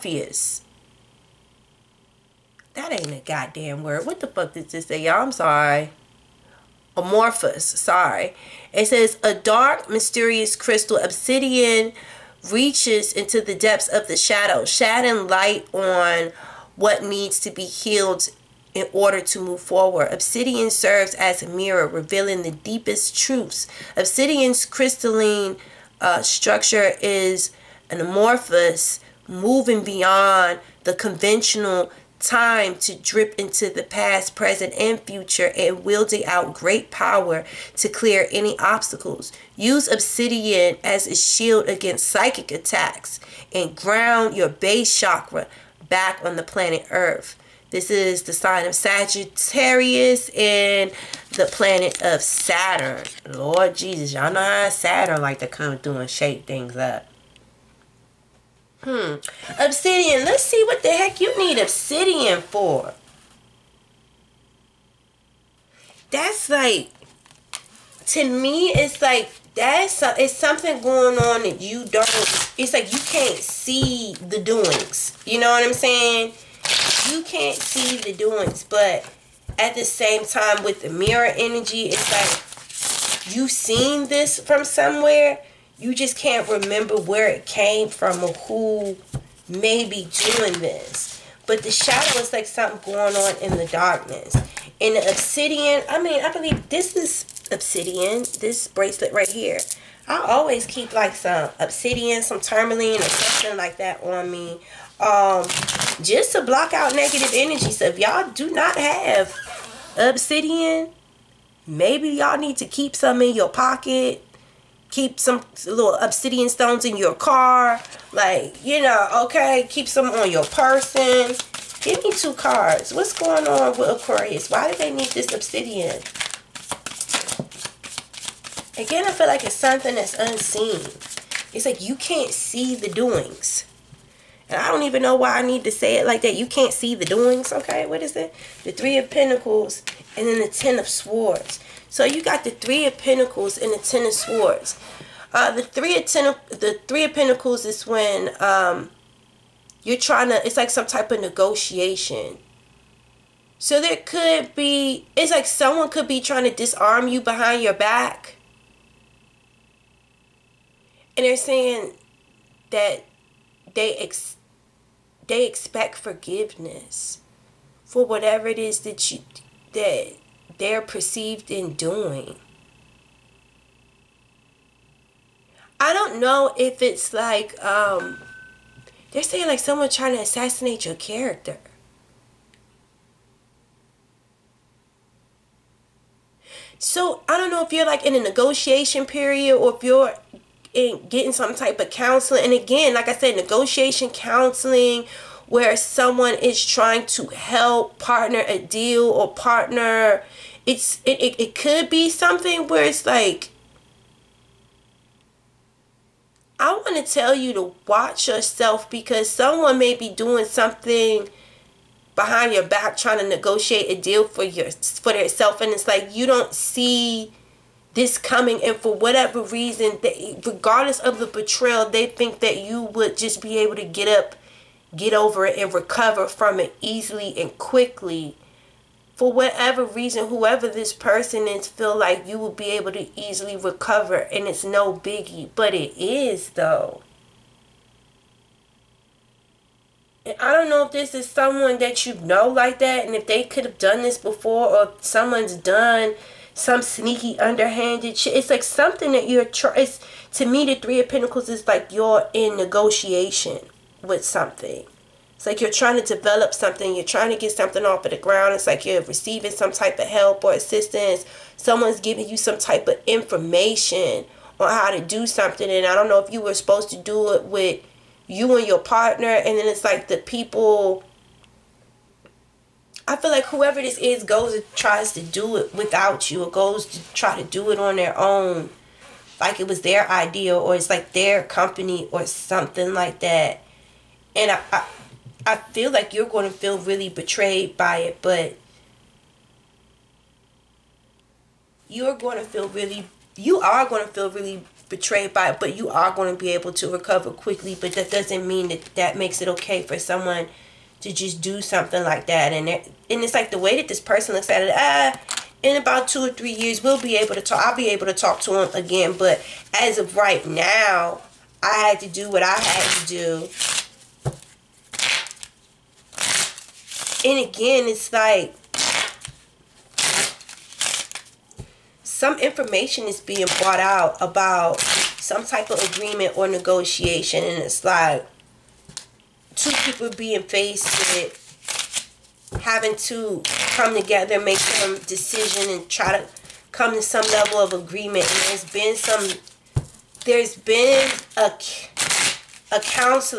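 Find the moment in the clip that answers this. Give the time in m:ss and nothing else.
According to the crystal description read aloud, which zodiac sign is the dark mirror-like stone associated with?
0:48.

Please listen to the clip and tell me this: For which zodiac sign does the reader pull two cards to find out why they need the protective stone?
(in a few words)
Aquarius.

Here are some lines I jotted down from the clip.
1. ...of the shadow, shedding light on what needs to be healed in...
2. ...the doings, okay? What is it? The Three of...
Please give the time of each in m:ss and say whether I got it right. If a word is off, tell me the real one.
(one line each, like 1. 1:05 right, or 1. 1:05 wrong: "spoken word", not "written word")
1. 0:13 right
2. 2:16 right.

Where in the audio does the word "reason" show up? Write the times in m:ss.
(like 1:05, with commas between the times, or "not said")
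3:39, 3:49.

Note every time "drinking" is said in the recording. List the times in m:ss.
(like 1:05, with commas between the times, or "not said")
not said.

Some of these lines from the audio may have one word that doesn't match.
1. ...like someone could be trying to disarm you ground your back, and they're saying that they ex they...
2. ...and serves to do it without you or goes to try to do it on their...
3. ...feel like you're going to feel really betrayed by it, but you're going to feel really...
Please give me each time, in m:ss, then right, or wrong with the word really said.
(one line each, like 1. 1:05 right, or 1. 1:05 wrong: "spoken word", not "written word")
1. 2:35 wrong: "behind", not "ground"
2. 4:34 wrong: "tries", not "serves"
3. 4:45 right.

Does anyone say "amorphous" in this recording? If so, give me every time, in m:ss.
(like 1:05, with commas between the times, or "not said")
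0:06, 0:28.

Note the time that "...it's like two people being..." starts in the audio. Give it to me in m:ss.
5:27.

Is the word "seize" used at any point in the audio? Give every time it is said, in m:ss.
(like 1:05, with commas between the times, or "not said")
not said.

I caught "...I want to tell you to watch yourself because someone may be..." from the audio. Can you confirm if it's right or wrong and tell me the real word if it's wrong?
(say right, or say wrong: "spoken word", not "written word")
right.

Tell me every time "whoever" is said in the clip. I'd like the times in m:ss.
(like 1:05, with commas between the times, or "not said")
3:50, 4:33.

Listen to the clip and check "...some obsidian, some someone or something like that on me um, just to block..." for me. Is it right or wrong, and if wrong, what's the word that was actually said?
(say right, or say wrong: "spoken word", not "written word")
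wrong: "tourmaline", not "someone".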